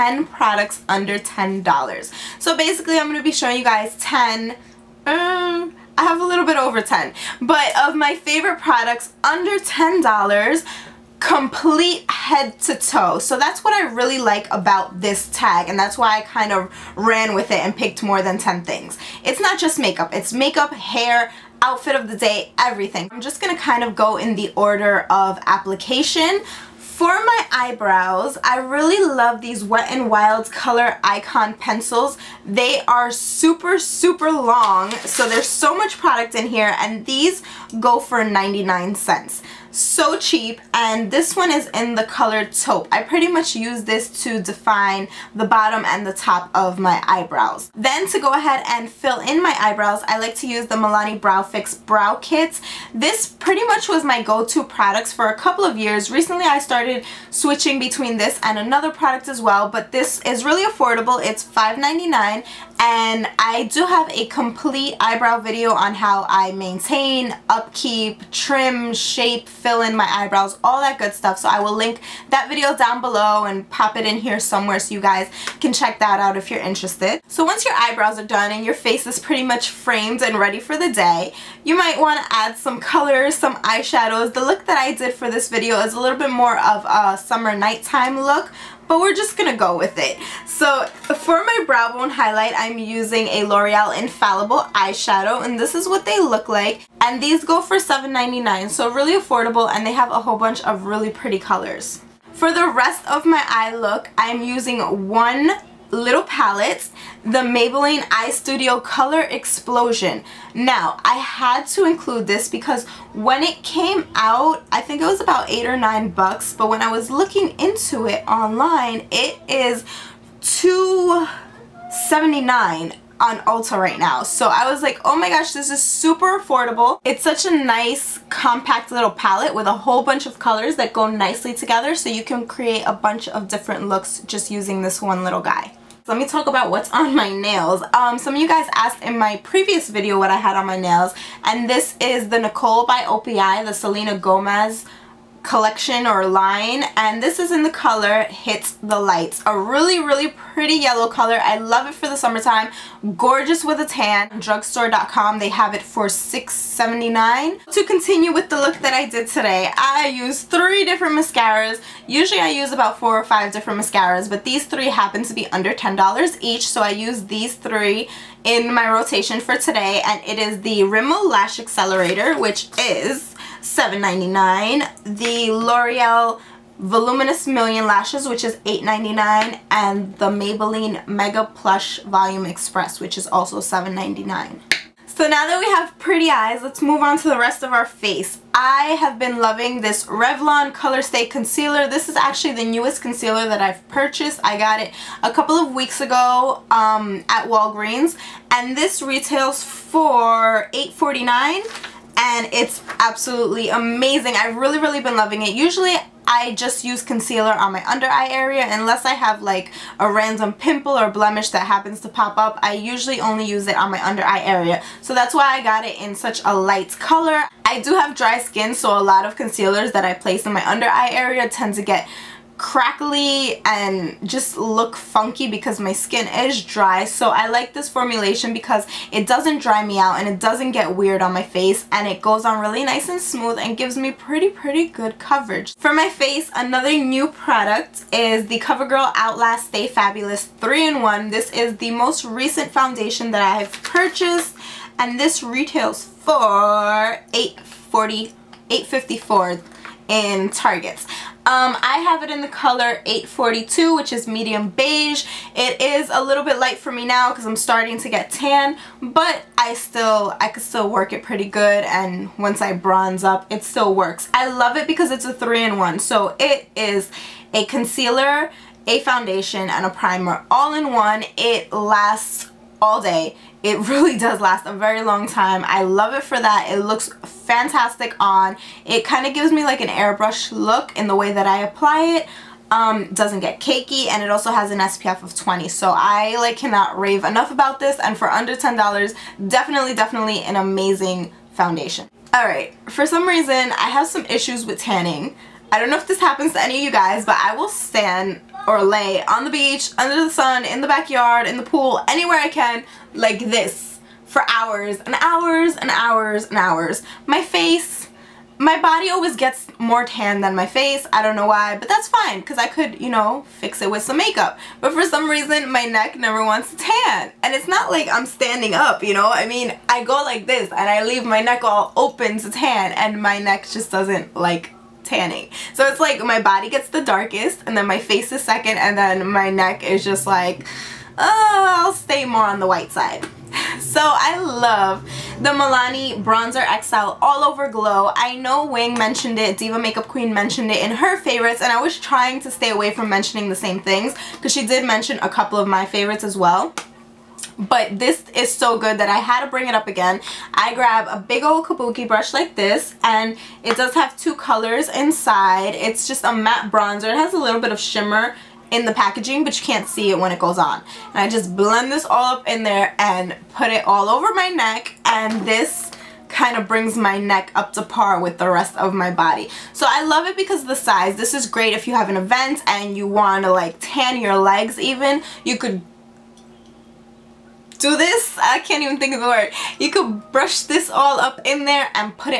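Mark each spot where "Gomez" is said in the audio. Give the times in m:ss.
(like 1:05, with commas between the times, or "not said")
2:24.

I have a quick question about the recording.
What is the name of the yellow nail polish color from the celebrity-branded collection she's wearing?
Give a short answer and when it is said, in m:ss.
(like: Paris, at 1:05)
Hits the Lights, at 2:28.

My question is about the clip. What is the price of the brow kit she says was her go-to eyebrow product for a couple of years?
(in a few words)
$5.99.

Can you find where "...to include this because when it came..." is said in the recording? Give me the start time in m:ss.
1:51.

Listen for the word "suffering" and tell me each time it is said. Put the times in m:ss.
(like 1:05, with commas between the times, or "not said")
not said.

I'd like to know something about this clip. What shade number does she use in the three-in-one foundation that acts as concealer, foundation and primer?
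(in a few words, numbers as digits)
842.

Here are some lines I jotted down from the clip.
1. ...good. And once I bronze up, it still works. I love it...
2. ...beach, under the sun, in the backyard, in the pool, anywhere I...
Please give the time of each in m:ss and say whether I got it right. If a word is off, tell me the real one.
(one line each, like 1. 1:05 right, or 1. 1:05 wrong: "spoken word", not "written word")
1. 4:21 right
2. 4:59 right.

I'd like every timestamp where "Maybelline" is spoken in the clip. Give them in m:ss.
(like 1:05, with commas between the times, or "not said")
1:47, 3:00.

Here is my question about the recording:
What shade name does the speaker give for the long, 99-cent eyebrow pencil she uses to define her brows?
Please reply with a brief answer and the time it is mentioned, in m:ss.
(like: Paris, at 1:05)
taupe, at 0:42.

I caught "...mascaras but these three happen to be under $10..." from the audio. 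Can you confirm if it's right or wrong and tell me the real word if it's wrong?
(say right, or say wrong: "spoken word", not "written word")
right.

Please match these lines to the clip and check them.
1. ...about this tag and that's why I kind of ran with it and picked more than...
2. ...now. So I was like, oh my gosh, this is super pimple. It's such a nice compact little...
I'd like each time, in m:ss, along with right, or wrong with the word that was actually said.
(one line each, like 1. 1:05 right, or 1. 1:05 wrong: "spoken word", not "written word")
1. 0:14 right
2. 2:03 wrong: "affordable", not "pimple".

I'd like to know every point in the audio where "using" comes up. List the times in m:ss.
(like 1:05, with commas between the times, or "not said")
1:32, 1:44, 2:14.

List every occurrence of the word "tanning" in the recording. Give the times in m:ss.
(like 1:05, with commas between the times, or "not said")
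4:54, 5:25.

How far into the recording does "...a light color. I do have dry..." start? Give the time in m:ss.
3:36.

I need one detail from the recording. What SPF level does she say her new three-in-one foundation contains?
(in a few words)
20.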